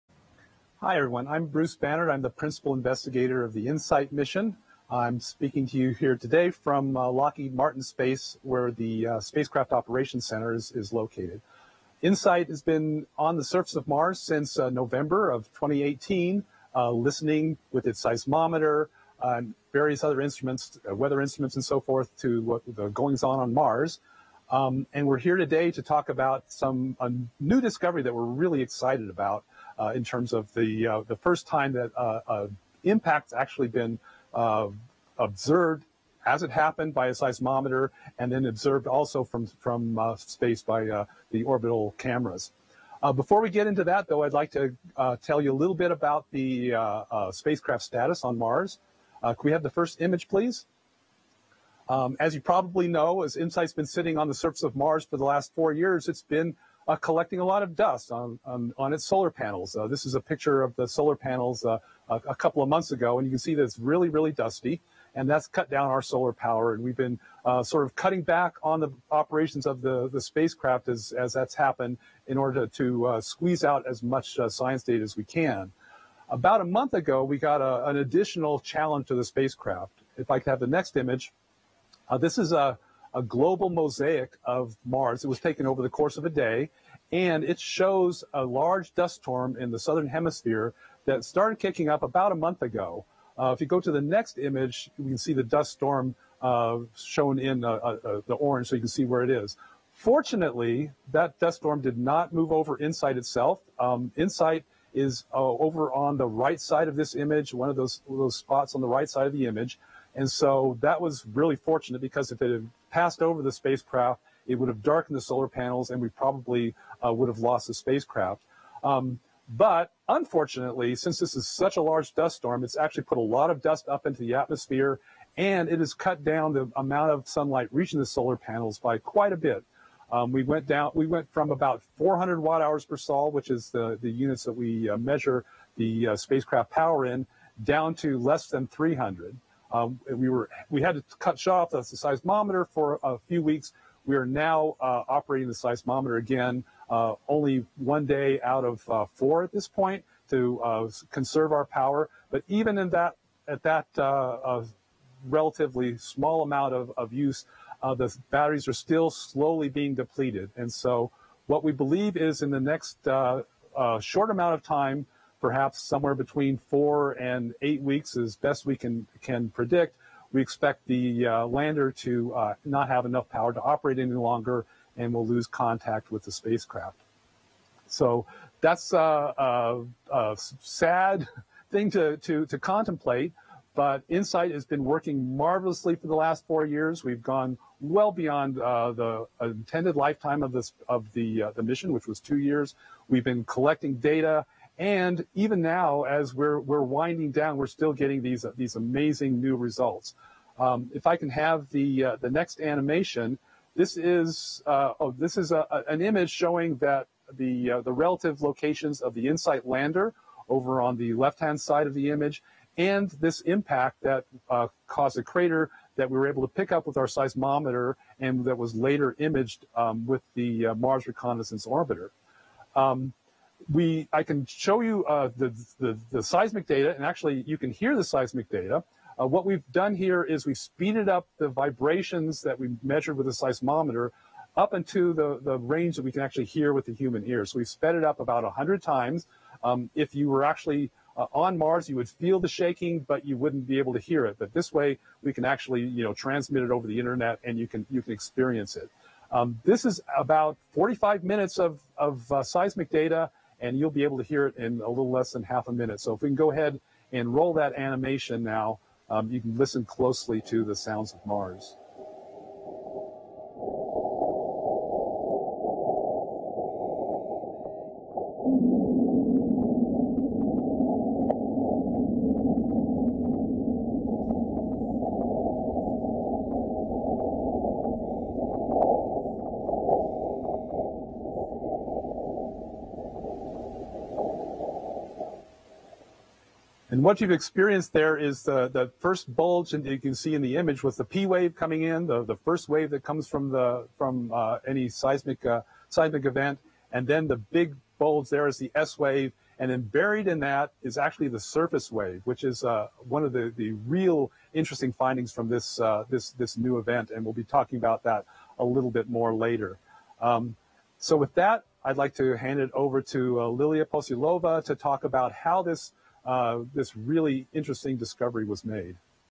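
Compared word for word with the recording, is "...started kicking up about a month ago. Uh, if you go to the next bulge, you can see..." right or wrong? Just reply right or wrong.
wrong.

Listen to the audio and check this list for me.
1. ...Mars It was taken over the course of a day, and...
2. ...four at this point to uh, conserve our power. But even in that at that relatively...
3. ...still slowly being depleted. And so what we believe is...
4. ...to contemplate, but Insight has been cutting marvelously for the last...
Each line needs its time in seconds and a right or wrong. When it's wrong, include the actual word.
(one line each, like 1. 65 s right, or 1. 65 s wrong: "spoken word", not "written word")
1. 84 s right
2. 149 s right
3. 158 s right
4. 182 s wrong: "working", not "cutting".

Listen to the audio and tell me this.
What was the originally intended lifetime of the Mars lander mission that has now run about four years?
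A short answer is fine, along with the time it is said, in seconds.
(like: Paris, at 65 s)
two years, at 192 s.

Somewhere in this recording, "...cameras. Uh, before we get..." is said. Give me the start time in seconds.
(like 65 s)
41 s.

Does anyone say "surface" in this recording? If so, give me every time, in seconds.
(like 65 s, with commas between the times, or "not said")
13 s, 54 s, 301 s.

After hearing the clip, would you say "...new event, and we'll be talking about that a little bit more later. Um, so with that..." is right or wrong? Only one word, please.
right.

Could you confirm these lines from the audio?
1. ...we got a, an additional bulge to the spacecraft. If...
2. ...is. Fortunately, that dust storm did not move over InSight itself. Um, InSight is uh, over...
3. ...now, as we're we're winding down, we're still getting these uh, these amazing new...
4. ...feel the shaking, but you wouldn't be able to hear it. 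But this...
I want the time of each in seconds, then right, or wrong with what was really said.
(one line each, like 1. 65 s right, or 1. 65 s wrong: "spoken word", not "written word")
1. 77 s wrong: "challenge", not "bulge"
2. 99 s right
3. 195 s right
4. 242 s right.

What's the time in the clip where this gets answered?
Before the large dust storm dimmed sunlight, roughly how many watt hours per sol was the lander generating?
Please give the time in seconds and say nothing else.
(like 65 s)
131 s.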